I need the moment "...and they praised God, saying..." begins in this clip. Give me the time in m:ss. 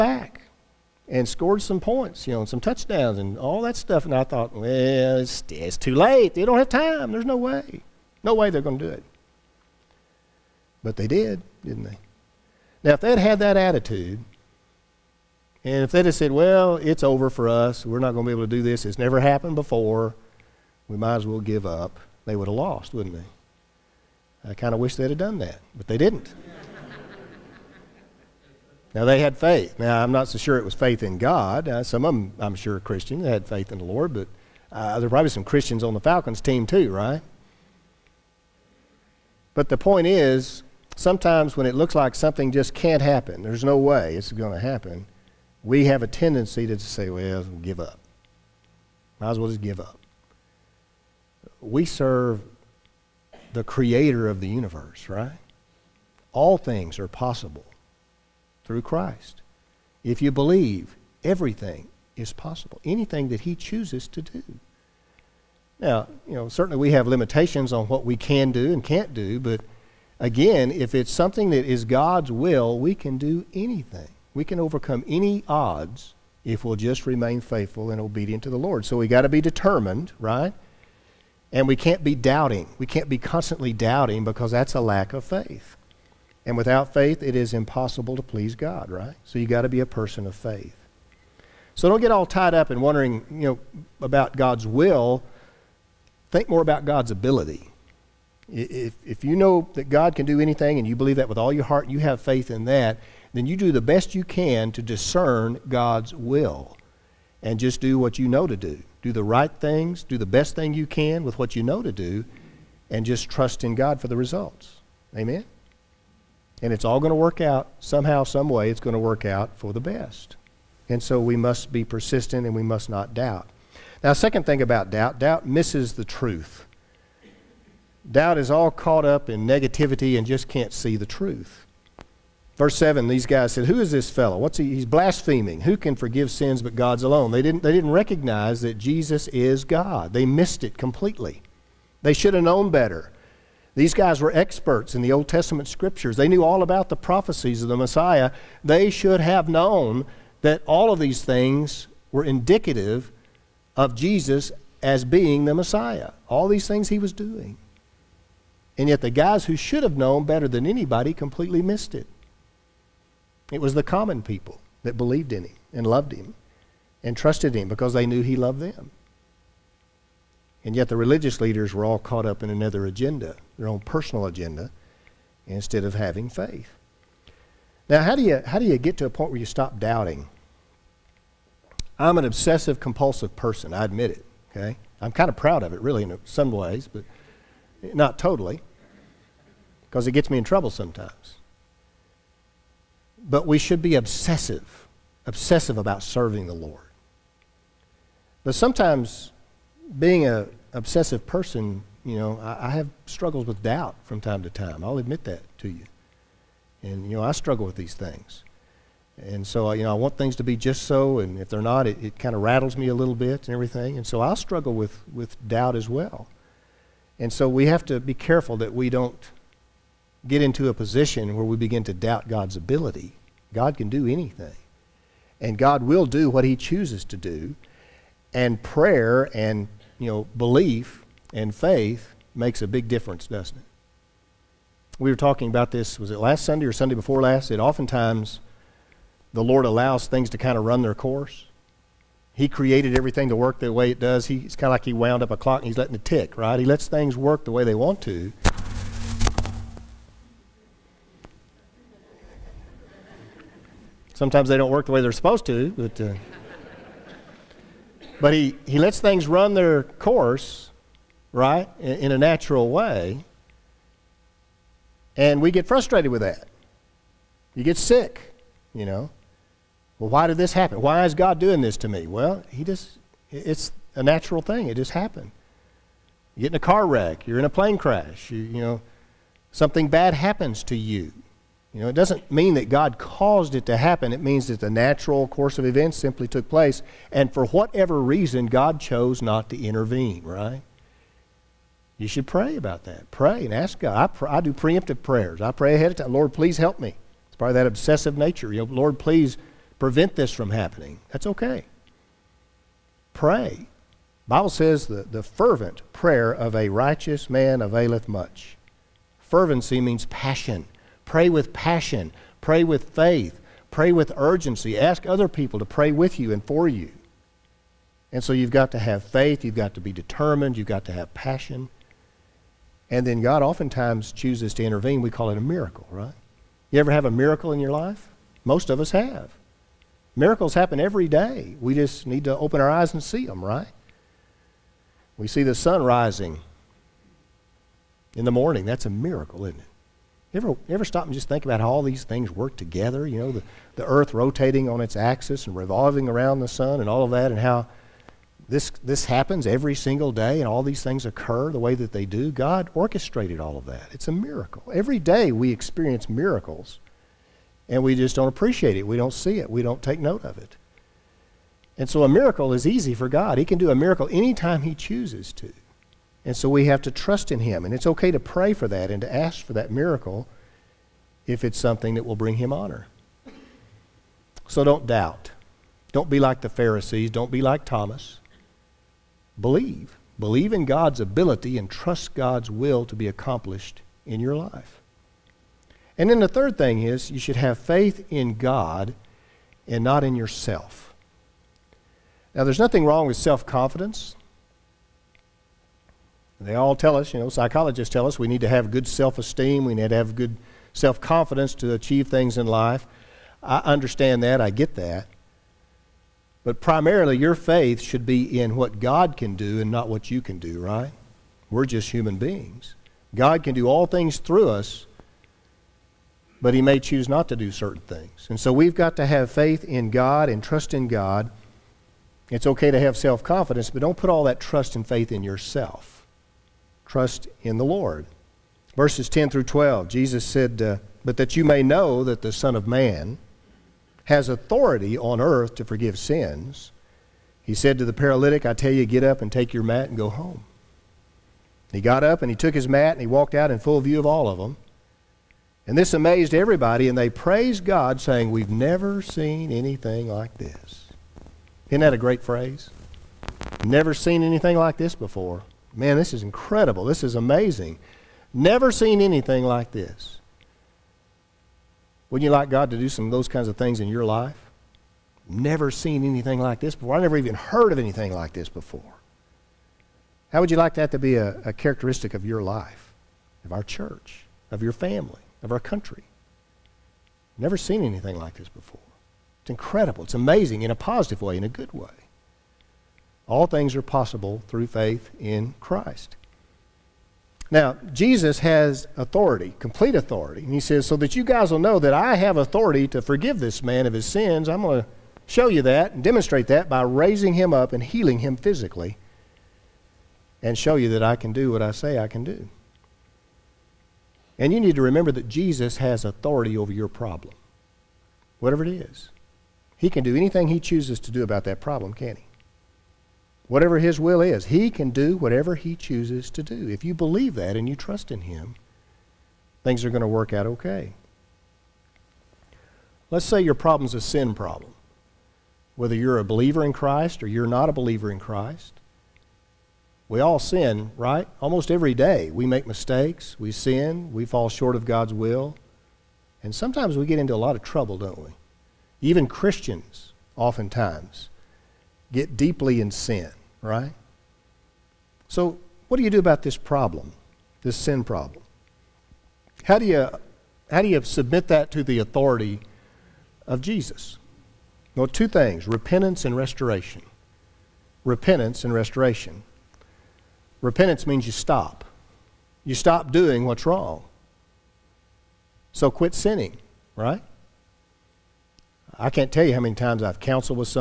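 7:26.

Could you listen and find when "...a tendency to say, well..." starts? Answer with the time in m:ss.
0:46.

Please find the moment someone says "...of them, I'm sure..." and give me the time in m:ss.
0:32.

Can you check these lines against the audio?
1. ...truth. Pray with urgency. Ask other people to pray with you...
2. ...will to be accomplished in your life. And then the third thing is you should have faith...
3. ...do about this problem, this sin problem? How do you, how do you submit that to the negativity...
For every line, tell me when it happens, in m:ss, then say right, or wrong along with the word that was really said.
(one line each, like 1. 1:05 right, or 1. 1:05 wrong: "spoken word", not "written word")
1. 5:12 wrong: "faith", not "truth"
2. 6:22 right
3. 9:06 wrong: "authority", not "negativity".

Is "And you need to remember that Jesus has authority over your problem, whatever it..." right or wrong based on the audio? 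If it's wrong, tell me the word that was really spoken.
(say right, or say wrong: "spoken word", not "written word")
right.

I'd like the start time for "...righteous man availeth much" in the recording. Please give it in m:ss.
5:06.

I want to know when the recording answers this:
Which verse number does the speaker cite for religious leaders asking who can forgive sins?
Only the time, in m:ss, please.
2:12.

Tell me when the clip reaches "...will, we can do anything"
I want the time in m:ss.
1:12.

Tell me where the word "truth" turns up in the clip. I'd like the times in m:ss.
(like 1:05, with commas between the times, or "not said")
2:06, 2:11.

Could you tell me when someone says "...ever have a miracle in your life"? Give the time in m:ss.
5:26.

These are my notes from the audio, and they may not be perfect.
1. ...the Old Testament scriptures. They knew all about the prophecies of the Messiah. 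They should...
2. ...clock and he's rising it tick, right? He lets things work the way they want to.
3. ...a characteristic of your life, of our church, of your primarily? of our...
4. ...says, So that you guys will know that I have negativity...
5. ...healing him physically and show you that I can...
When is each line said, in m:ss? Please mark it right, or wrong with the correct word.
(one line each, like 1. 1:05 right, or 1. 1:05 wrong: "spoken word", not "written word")
1. 2:25 right
2. 4:05 wrong: "letting", not "rising"
3. 7:51 wrong: "family", not "primarily"
4. 8:10 wrong: "authority", not "negativity"
5. 8:17 right.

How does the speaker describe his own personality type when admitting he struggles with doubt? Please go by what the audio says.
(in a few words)
Obsessive compulsive.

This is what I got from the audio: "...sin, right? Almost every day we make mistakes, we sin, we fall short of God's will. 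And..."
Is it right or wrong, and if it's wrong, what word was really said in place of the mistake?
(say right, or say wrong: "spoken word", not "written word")
right.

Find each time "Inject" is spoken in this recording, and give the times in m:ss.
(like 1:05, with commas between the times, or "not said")
not said.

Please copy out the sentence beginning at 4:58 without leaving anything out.
You know, Lord, please prevent this from happening, that's okay.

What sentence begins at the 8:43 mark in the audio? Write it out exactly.
Let's say your problem's a sin problem.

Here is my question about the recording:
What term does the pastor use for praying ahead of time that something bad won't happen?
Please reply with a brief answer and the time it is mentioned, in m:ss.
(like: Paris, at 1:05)
Preemptive prayers, at 4:54.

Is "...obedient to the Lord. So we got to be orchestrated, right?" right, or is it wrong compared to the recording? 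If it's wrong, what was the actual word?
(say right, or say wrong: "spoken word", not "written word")
wrong: "determined", not "orchestrated".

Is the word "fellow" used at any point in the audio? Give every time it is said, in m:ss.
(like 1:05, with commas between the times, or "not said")
2:14.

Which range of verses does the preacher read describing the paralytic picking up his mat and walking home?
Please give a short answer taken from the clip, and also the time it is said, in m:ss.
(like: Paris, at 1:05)
10 through 12, at 7:08.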